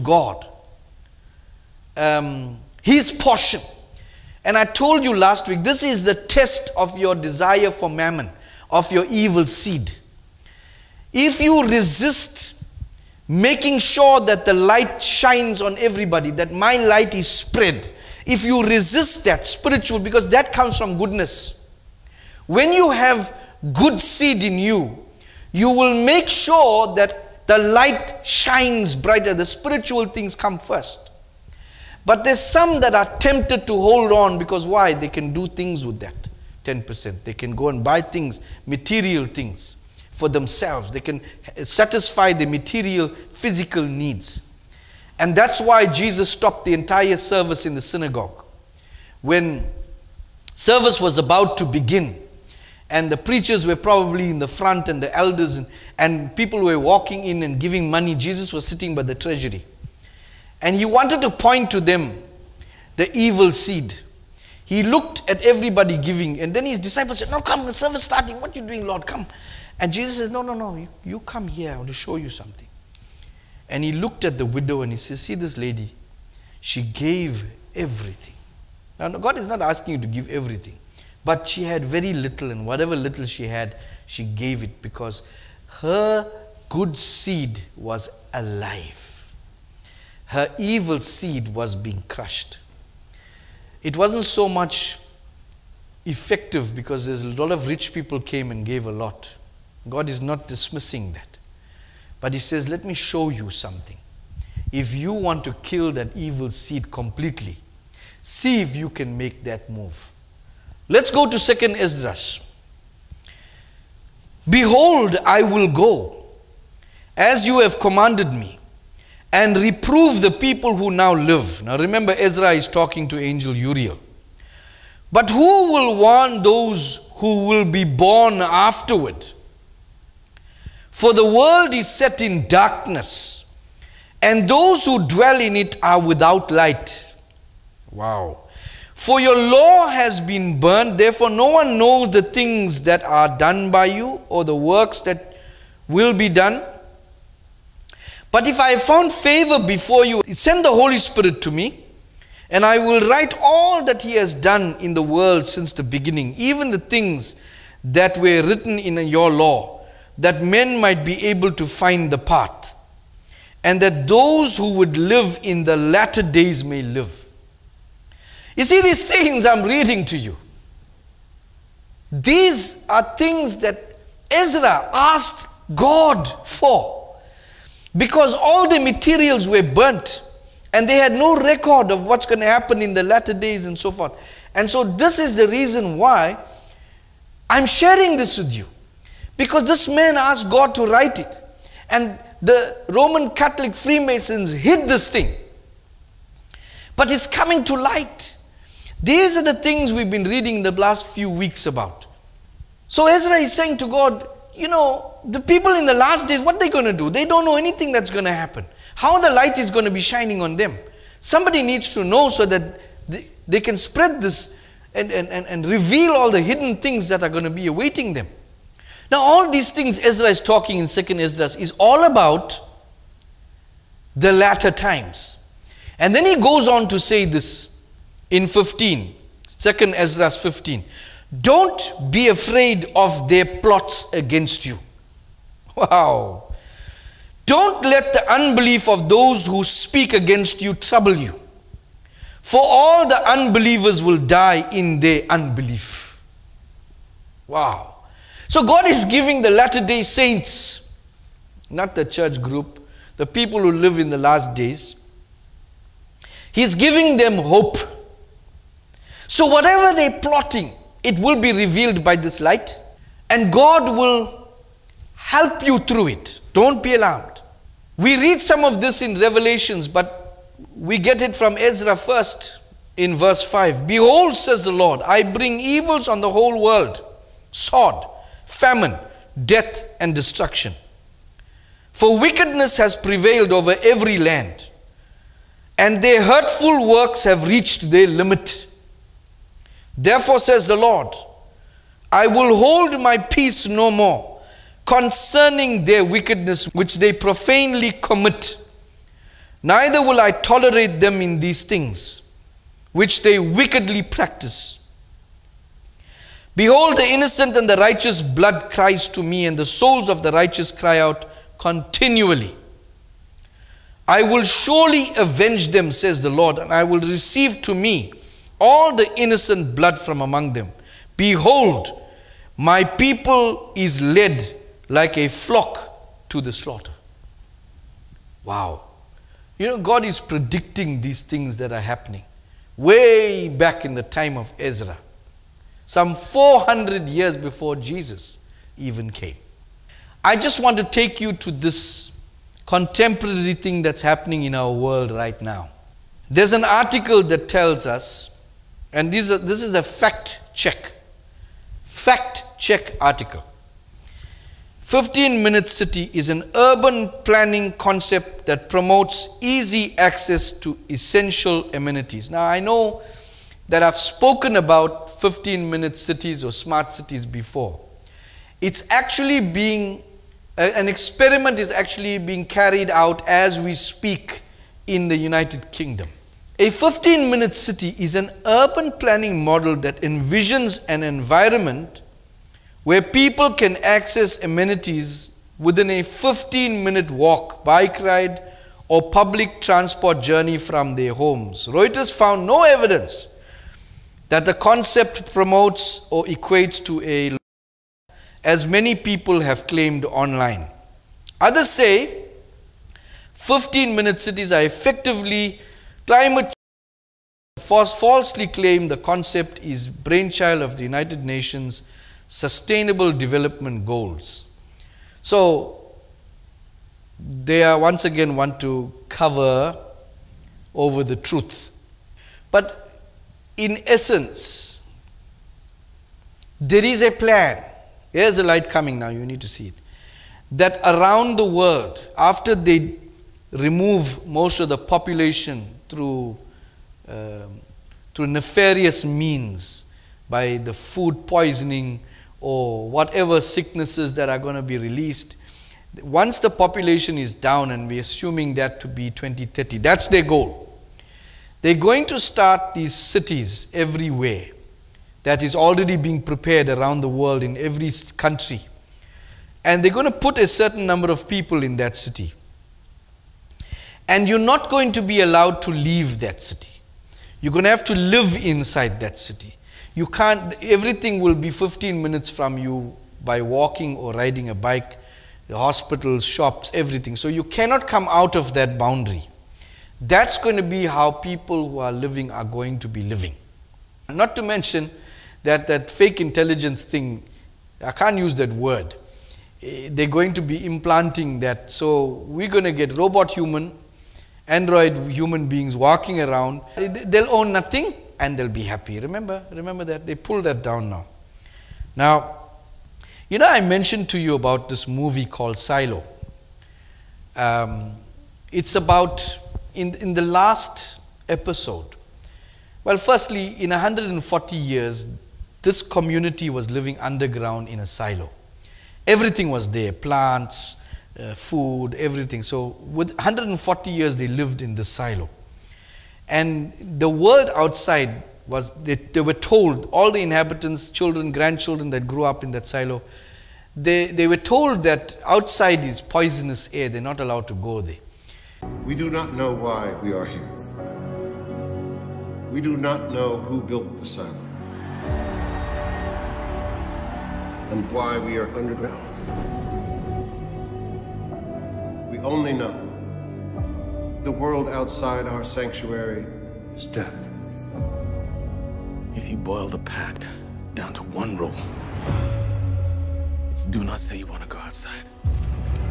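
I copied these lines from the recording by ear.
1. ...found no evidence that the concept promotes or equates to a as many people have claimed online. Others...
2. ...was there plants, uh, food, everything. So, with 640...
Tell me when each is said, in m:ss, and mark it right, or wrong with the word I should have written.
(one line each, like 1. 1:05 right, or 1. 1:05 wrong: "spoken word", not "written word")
1. 6:32 right
2. 8:39 wrong: "140", not "640".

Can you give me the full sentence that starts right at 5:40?
I just want to take you to this contemporary thing that's happening in our world right now.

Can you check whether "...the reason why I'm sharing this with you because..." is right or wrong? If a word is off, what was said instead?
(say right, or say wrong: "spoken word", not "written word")
right.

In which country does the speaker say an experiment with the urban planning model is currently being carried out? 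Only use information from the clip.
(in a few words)
United Kingdom.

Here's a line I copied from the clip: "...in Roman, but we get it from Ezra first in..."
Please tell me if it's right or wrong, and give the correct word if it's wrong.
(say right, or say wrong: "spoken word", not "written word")
wrong: "Revelations", not "Roman".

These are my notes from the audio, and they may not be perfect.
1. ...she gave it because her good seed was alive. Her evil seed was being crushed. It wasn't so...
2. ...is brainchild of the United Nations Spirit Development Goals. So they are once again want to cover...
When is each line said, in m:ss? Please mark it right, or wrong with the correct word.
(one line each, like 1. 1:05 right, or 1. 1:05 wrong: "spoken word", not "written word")
1. 1:24 right
2. 6:49 wrong: "Sustainable", not "Spirit".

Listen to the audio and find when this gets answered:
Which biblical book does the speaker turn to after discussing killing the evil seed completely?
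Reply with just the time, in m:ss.
1:51.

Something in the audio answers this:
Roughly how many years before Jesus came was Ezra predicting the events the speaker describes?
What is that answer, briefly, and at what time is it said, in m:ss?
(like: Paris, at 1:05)
400, at 5:36.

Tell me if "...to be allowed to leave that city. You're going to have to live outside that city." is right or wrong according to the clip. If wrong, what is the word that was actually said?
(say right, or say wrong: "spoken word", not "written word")
wrong: "inside", not "outside".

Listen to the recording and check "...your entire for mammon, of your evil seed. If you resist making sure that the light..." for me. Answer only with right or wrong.
wrong.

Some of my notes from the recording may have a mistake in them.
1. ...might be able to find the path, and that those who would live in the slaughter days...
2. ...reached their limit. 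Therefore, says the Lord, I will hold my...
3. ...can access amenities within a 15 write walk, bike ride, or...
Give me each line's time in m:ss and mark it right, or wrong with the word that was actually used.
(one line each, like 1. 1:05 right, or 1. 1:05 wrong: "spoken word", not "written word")
1. 2:40 wrong: "latter", not "slaughter"
2. 4:47 right
3. 6:23 wrong: "minute", not "write".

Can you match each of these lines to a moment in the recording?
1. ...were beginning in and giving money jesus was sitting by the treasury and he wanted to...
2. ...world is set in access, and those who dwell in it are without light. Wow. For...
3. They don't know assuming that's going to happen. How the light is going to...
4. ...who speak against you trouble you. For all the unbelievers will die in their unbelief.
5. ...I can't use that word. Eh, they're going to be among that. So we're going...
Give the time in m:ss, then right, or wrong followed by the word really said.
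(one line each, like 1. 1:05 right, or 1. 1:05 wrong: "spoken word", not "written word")
1. 0:56 wrong: "walking", not "beginning"
2. 2:11 wrong: "darkness", not "access"
3. 3:27 wrong: "anything", not "assuming"
4. 3:59 right
5. 8:07 wrong: "implanting", not "among".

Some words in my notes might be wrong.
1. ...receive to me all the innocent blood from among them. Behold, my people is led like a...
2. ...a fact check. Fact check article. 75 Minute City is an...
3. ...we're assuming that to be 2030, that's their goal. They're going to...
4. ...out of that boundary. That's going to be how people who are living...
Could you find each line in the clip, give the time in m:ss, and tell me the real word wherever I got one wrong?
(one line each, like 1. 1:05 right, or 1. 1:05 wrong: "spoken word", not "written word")
1. 5:17 right
2. 5:49 wrong: "15", not "75"
3. 7:27 right
4. 7:58 right.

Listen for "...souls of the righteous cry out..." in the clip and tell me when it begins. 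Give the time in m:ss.
5:09.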